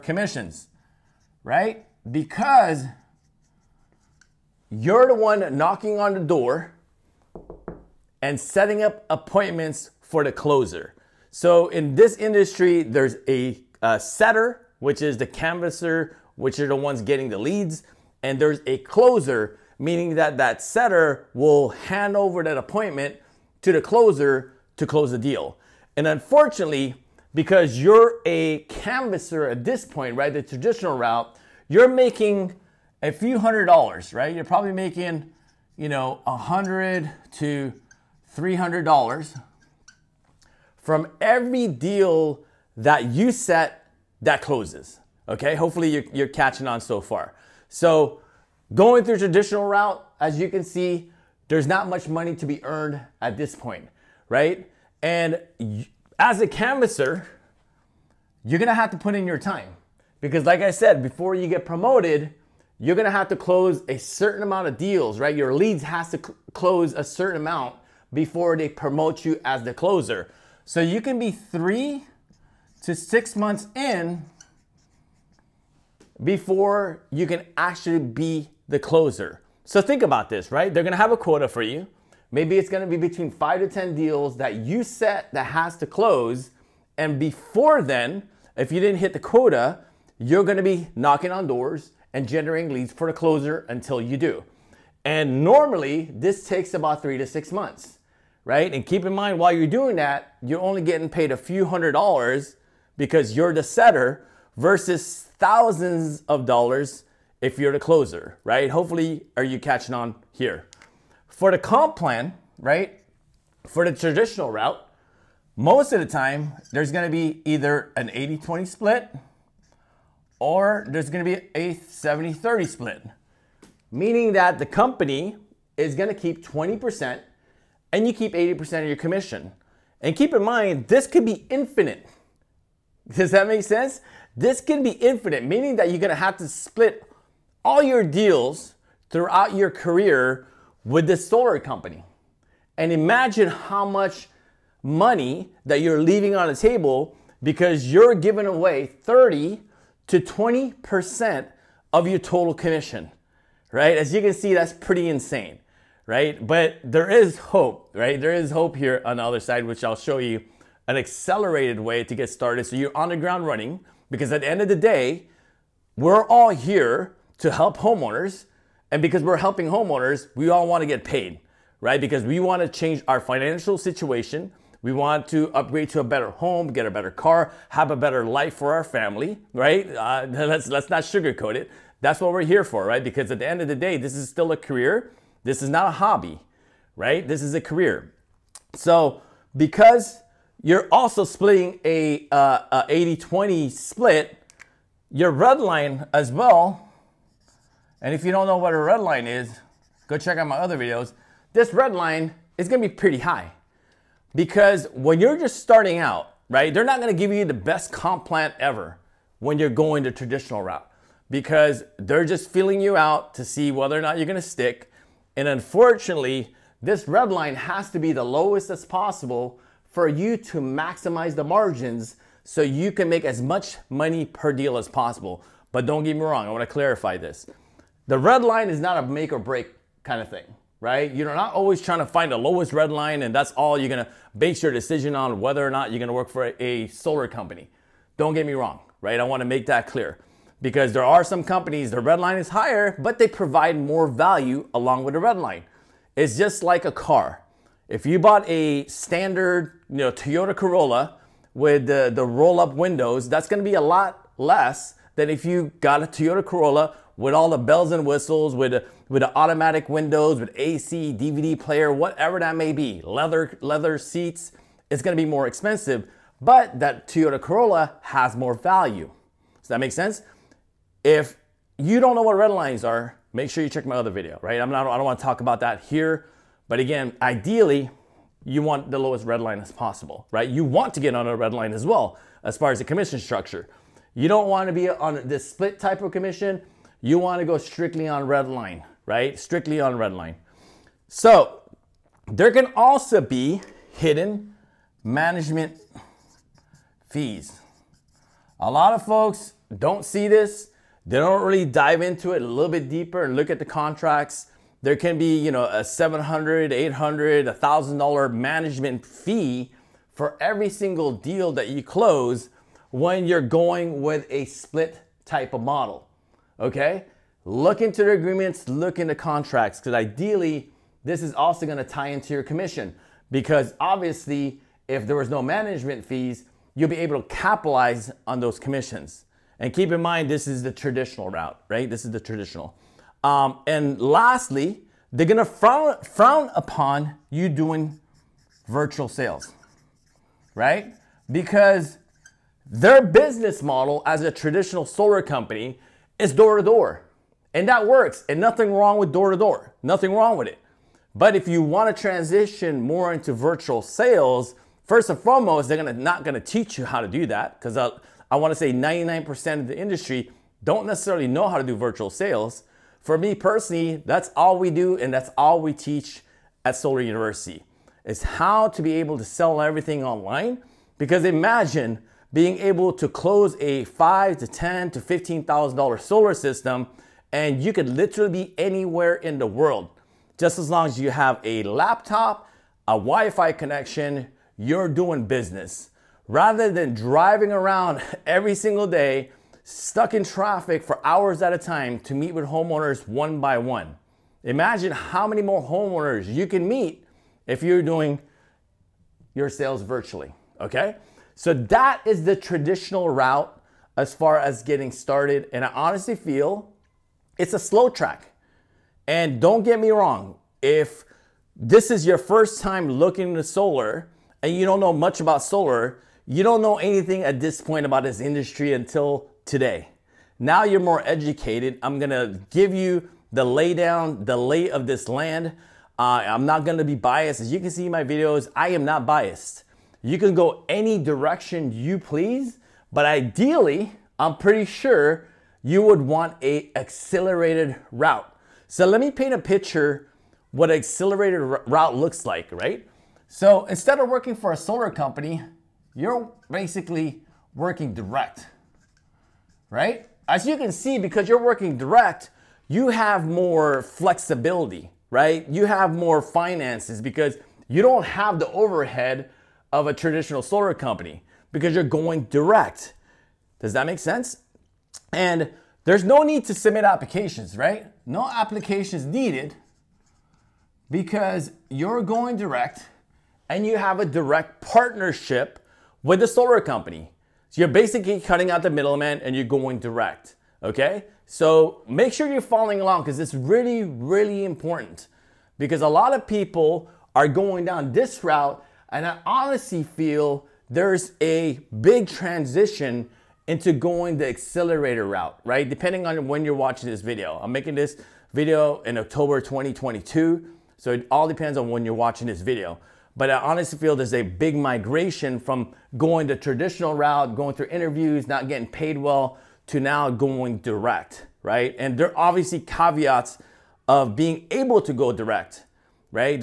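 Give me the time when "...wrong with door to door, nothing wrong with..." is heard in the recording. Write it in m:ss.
5:48.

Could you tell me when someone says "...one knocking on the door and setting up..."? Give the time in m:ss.
0:05.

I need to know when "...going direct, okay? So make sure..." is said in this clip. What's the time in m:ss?
7:59.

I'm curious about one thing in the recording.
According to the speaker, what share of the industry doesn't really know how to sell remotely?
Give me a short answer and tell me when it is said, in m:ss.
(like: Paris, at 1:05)
99%, at 5:58.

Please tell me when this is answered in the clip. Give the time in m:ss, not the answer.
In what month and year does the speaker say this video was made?
8:18.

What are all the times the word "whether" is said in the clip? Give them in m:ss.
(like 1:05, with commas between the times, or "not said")
3:33, 3:55.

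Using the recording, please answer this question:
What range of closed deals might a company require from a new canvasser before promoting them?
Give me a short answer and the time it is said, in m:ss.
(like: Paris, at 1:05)
5 to 10, at 1:23.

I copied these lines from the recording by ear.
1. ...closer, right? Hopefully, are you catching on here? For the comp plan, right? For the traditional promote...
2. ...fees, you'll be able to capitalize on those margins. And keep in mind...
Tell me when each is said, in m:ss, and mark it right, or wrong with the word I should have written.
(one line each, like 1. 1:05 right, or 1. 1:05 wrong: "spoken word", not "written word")
1. 1:47 wrong: "route", not "promote"
2. 5:26 wrong: "commissions", not "margins".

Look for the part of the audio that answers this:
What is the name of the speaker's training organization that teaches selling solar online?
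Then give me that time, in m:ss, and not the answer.
6:06.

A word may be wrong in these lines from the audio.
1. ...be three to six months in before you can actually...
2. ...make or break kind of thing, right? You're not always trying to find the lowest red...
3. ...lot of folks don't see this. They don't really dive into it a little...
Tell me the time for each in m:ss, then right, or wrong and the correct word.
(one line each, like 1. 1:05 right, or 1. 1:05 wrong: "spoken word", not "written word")
1. 1:11 right
2. 3:49 right
3. 4:58 right.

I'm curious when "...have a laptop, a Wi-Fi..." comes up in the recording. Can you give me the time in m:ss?
6:21.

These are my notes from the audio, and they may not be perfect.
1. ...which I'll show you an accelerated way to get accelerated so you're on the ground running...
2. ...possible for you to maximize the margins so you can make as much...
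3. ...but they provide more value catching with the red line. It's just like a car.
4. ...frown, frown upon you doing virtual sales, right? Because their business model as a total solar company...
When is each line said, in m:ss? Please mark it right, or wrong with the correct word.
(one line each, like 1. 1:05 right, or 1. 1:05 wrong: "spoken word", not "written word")
1. 2:39 wrong: "started", not "accelerated"
2. 3:38 right
3. 4:02 wrong: "along", not "catching"
4. 5:35 wrong: "traditional", not "total".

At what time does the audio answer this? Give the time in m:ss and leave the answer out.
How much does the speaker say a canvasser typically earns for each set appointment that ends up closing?
0:36.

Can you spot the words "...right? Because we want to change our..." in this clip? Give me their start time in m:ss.
2:51.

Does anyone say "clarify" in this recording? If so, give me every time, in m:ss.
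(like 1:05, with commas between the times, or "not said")
3:46.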